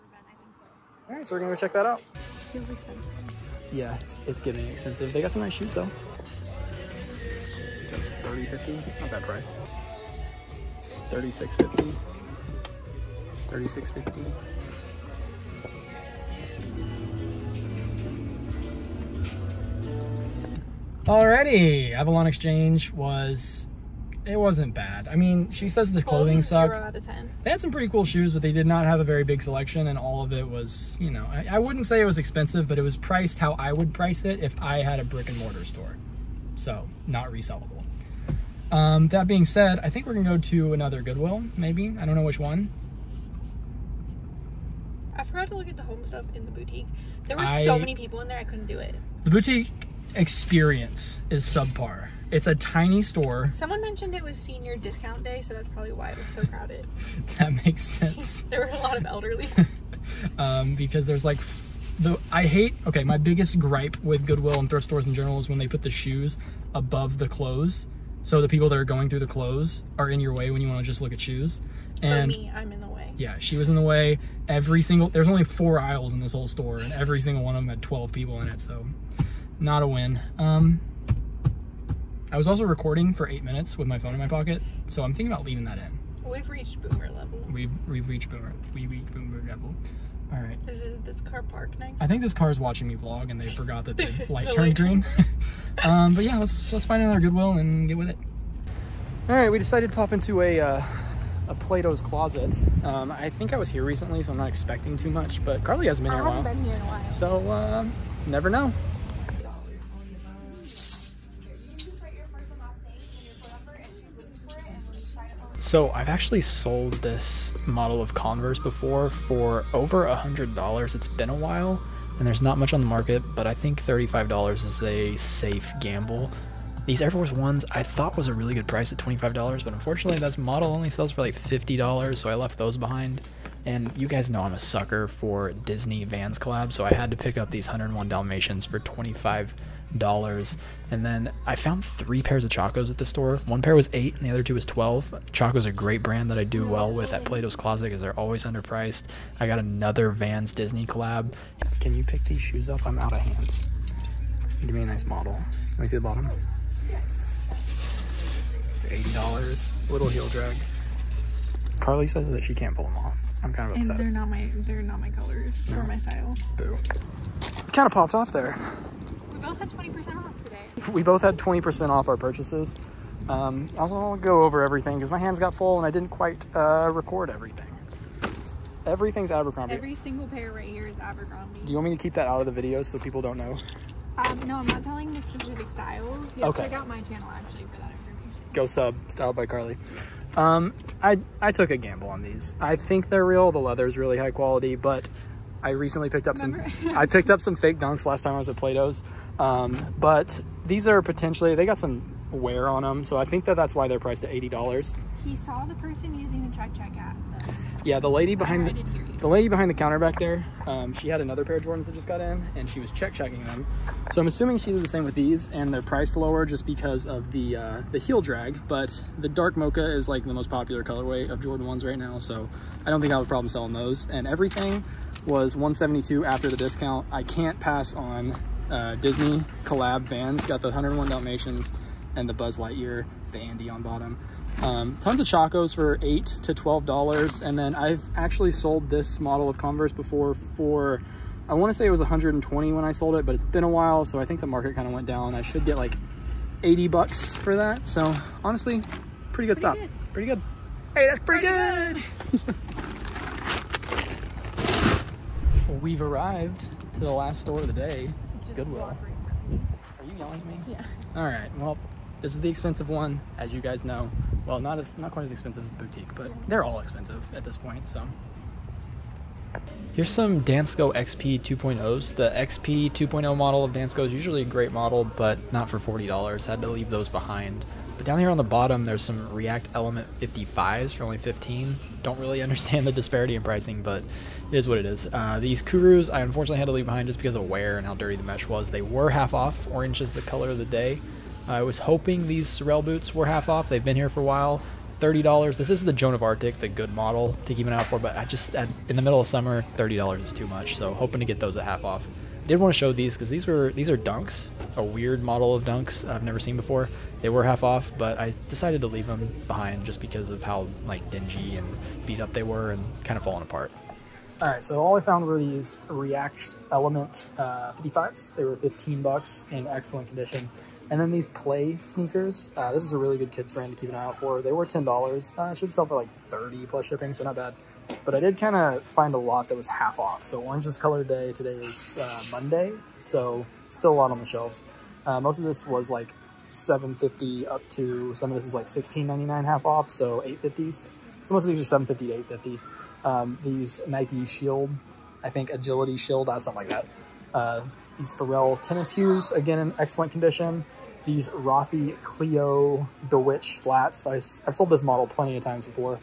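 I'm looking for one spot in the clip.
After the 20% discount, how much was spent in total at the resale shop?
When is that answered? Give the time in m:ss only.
3:45.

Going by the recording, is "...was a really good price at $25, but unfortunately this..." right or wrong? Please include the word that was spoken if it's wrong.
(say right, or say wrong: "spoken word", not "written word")
right.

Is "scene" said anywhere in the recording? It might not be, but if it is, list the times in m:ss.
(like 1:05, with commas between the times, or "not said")
not said.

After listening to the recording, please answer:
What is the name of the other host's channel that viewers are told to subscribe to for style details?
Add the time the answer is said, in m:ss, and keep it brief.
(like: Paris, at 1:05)
styled by Carli, at 3:09.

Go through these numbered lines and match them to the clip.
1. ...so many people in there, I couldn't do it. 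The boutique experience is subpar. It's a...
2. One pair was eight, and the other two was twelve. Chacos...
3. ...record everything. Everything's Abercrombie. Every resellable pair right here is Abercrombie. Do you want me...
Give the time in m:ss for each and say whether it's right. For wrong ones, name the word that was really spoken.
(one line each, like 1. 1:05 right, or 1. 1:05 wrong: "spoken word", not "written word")
1. 0:47 right
2. 2:23 right
3. 2:56 wrong: "single", not "resellable".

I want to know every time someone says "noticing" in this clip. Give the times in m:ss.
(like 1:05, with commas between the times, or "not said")
not said.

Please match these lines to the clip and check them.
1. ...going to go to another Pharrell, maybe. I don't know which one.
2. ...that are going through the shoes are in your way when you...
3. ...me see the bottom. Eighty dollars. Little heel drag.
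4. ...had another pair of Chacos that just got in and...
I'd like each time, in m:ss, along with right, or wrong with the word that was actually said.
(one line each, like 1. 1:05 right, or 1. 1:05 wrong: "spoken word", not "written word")
1. 0:40 wrong: "Goodwill", not "Pharrell"
2. 1:08 wrong: "clothes", not "shoes"
3. 2:35 right
4. 3:31 wrong: "Jordans", not "Chacos".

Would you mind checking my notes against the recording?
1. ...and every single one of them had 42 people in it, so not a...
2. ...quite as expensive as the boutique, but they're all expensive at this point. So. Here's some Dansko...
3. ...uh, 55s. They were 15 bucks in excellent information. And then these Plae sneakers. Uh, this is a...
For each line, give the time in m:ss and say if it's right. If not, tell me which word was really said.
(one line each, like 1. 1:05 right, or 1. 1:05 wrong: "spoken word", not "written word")
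1. 1:16 wrong: "12", not "42"
2. 4:25 right
3. 5:17 wrong: "condition", not "information".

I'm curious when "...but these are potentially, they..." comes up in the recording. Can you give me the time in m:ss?
3:19.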